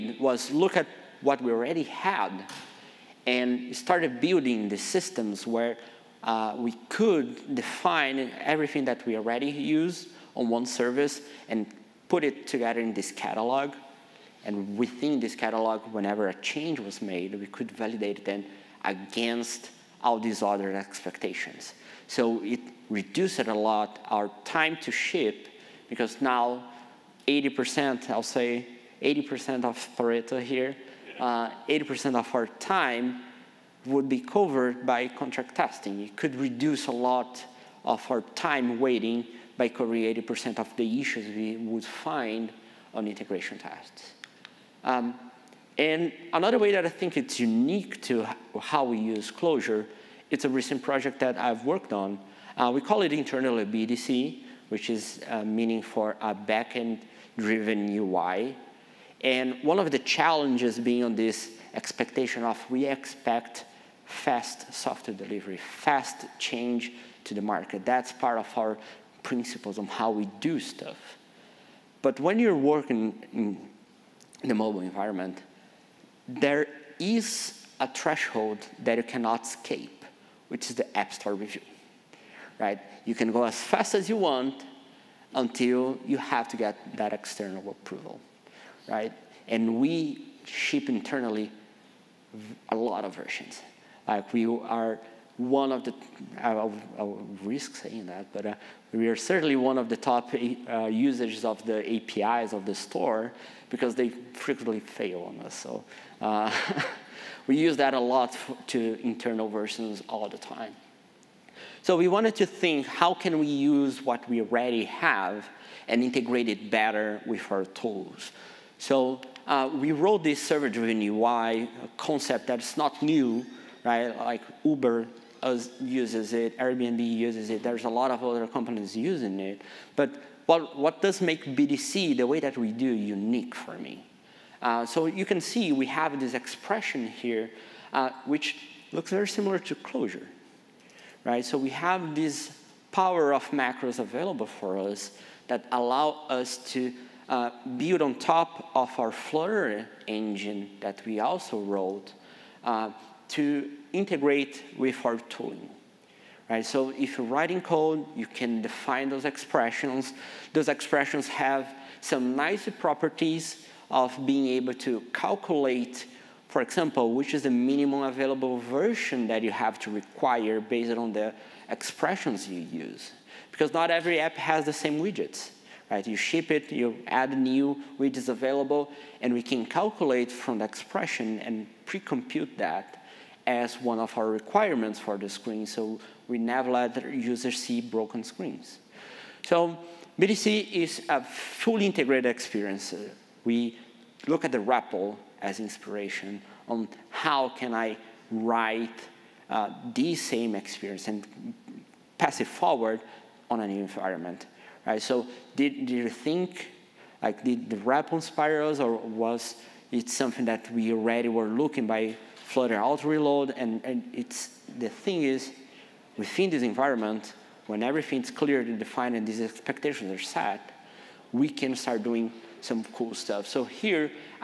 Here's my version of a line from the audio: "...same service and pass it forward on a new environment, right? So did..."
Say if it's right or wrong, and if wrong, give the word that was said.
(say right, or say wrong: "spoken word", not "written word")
wrong: "experience", not "service".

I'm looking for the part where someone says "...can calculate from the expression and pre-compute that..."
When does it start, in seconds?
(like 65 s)
179 s.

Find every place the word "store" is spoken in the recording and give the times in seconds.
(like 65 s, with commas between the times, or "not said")
81 s, 102 s.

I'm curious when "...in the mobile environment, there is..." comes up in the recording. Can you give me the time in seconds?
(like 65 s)
73 s.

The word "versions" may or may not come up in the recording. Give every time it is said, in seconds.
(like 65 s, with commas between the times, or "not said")
93 s, 109 s, 168 s.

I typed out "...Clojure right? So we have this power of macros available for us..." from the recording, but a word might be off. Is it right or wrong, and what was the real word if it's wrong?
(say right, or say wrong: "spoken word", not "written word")
right.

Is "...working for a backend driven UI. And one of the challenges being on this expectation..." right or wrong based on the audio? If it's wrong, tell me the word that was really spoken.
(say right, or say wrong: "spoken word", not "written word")
wrong: "meaning", not "working".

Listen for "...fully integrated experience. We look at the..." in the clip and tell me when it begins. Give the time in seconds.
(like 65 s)
191 s.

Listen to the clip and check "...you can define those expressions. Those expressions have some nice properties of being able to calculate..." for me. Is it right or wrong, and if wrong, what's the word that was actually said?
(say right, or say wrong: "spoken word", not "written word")
right.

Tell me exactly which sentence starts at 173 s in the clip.
Because not every app has the same widgets.